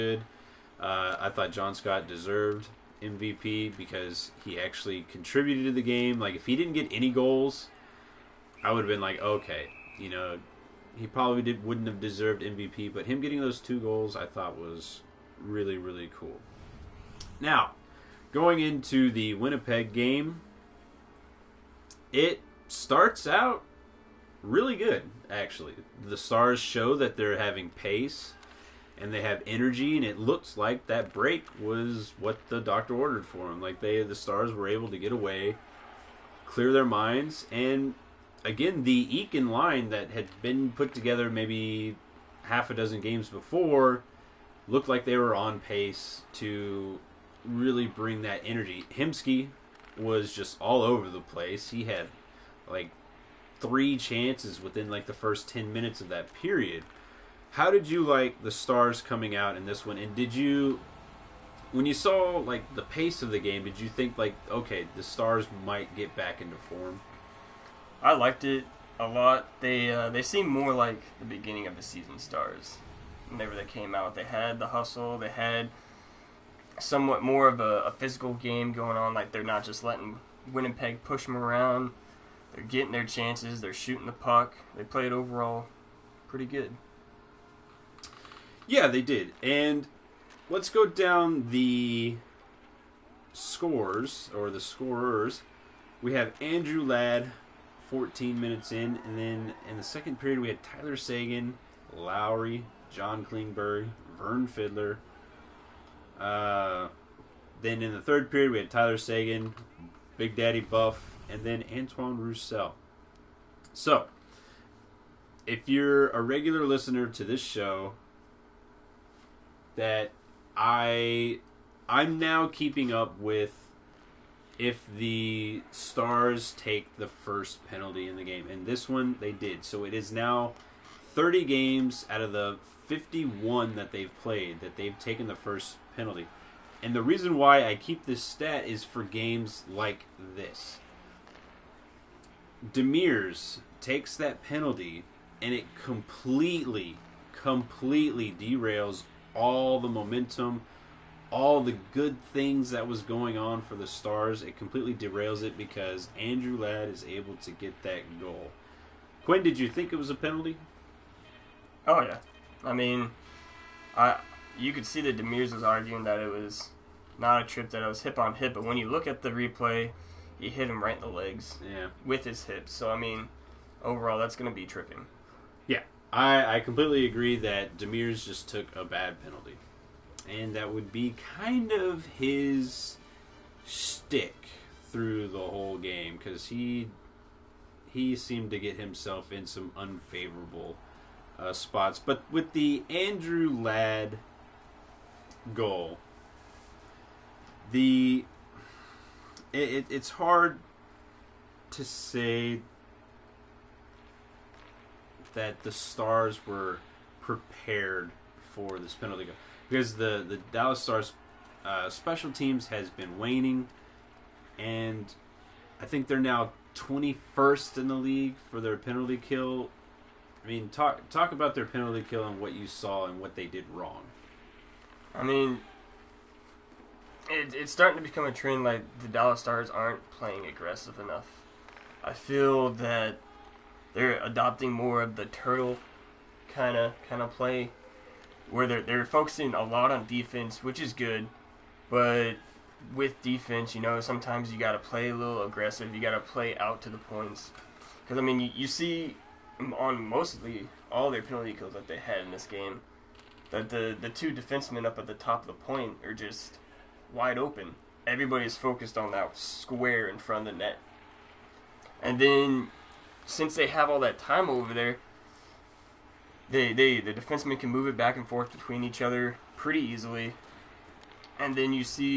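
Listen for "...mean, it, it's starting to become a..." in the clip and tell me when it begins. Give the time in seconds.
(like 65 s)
225 s.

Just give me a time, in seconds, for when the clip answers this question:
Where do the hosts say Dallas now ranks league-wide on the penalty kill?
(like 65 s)
216 s.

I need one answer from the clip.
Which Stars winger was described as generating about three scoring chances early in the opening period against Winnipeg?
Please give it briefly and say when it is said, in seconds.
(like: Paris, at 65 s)
Hemsky, at 48 s.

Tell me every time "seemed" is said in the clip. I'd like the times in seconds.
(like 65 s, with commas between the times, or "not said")
70 s, 188 s.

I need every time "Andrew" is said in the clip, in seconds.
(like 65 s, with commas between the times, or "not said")
96 s, 156 s, 192 s.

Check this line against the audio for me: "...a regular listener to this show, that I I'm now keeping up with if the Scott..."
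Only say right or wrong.
wrong.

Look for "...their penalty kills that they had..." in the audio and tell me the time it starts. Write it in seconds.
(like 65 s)
251 s.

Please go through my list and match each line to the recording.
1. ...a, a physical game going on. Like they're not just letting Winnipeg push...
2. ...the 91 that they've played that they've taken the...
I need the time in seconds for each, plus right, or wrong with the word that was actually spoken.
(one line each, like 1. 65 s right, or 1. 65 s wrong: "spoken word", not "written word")
1. 77 s right
2. 132 s wrong: "51", not "91".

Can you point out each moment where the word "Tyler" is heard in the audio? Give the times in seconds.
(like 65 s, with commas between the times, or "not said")
100 s, 108 s.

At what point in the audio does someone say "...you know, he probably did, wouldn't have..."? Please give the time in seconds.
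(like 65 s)
9 s.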